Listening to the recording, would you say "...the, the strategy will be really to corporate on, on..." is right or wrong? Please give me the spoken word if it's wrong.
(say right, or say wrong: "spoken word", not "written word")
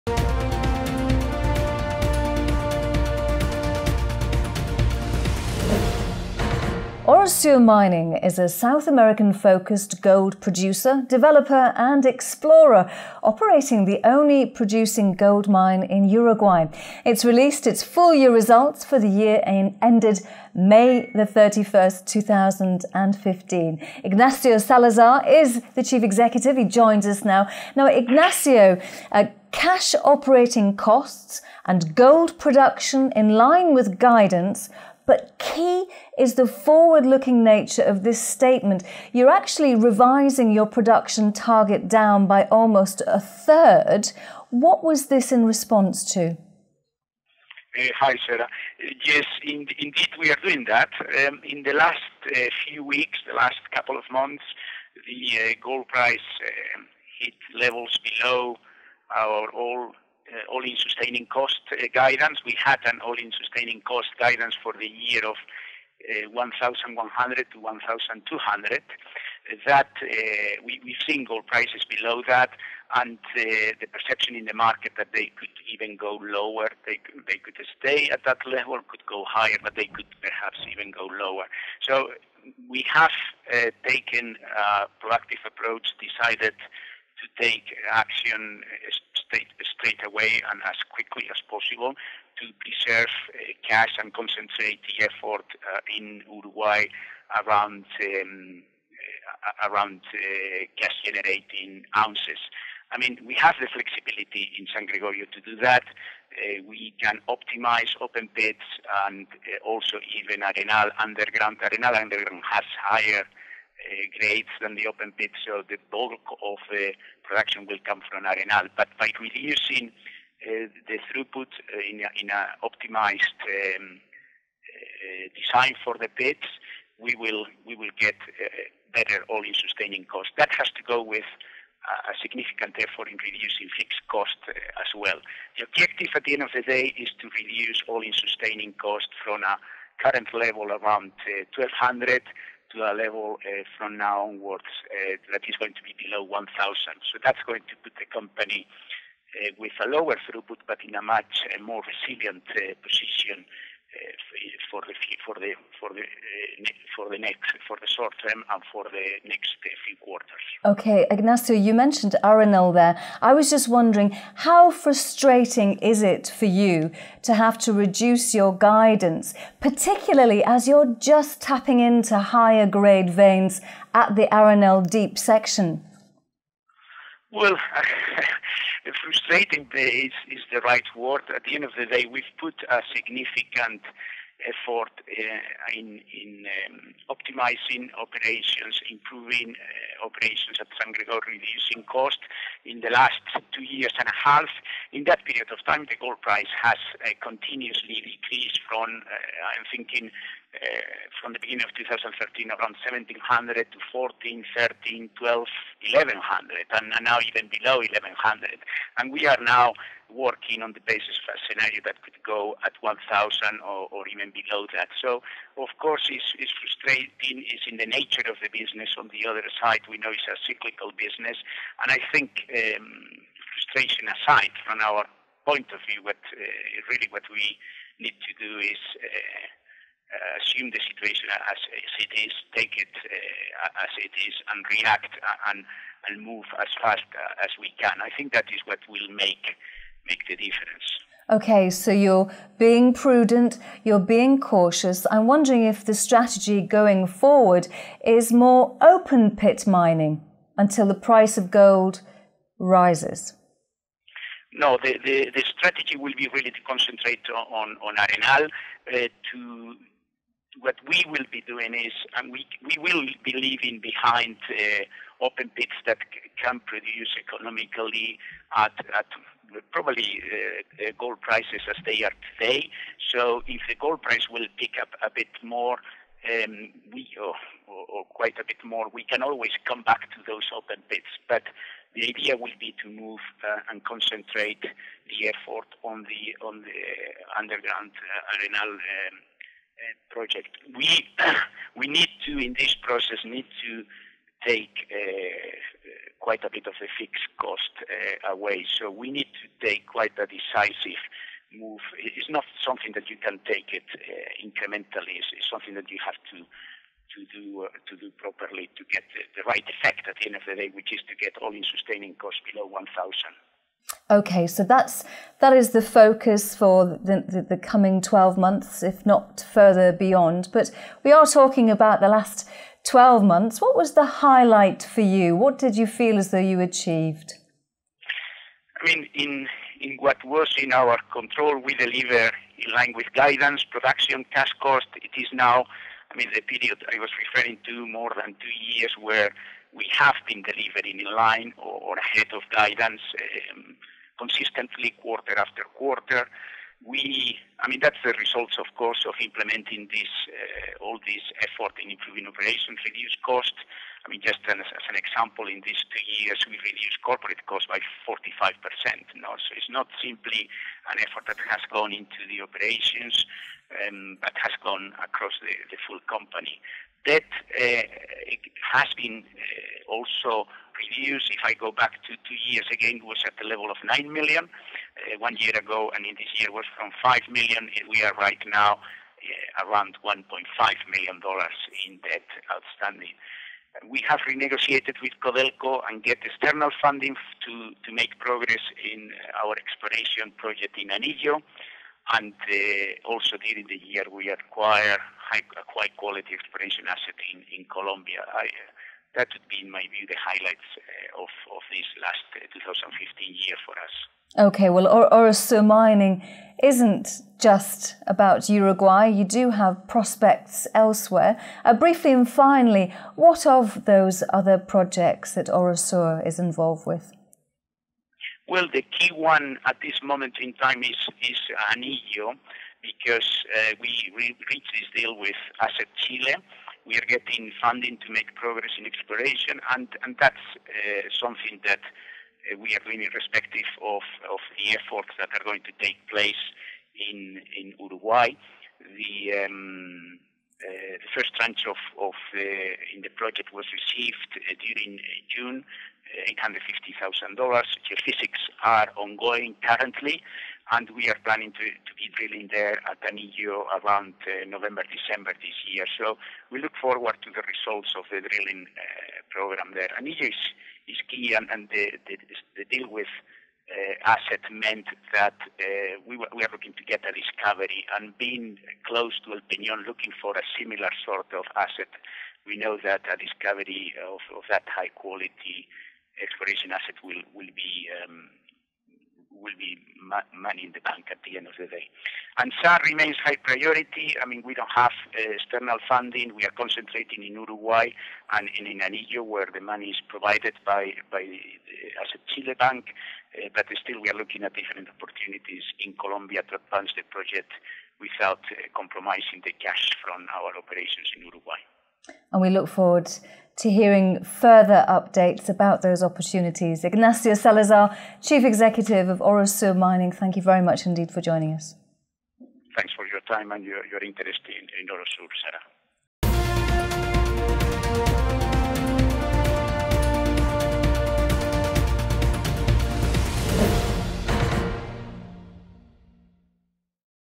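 wrong: "concentrate", not "corporate".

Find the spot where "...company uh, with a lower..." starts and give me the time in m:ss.
2:28.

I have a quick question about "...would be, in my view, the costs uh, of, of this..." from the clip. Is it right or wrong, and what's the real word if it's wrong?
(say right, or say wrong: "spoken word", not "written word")
wrong: "highlights", not "costs".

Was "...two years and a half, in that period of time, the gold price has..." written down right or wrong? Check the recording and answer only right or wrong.
right.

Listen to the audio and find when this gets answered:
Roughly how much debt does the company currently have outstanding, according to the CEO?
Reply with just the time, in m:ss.
6:20.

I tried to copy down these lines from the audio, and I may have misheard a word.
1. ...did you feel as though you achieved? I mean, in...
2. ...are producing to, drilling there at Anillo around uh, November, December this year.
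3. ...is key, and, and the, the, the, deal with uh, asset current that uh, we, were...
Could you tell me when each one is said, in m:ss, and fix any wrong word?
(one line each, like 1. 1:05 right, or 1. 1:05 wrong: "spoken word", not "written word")
1. 5:25 right
2. 7:31 wrong: "planning", not "producing"
3. 7:40 wrong: "meant", not "current".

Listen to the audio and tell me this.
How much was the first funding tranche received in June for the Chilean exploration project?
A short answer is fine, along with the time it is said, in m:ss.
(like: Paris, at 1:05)
$850,000, at 7:26.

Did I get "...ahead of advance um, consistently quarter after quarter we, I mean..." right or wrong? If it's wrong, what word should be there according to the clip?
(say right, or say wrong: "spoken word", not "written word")
wrong: "guidance", not "advance".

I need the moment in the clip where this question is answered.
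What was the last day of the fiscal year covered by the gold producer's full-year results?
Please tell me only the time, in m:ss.
0:20.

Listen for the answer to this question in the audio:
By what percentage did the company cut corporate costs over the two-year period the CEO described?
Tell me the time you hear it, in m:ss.
5:58.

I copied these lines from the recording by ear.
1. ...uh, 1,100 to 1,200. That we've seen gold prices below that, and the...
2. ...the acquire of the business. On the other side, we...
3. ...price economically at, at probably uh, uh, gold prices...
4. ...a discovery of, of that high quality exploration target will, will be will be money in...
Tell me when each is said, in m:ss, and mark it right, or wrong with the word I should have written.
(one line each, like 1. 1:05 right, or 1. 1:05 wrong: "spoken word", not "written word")
1. 1:06 right
2. 3:37 wrong: "nature", not "acquire"
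3. 4:26 wrong: "produce", not "price"
4. 7:53 wrong: "asset", not "target".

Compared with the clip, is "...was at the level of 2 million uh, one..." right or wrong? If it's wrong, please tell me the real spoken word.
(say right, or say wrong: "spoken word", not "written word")
wrong: "9", not "2".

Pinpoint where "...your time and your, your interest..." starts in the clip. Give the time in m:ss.
8:33.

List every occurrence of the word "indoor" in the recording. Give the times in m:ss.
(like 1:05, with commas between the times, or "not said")
not said.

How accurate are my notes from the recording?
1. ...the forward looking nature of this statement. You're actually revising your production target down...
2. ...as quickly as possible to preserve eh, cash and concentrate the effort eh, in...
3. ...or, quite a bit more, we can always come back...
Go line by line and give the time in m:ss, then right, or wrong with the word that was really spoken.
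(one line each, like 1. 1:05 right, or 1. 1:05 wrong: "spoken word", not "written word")
1. 0:36 right
2. 1:30 right
3. 4:37 right.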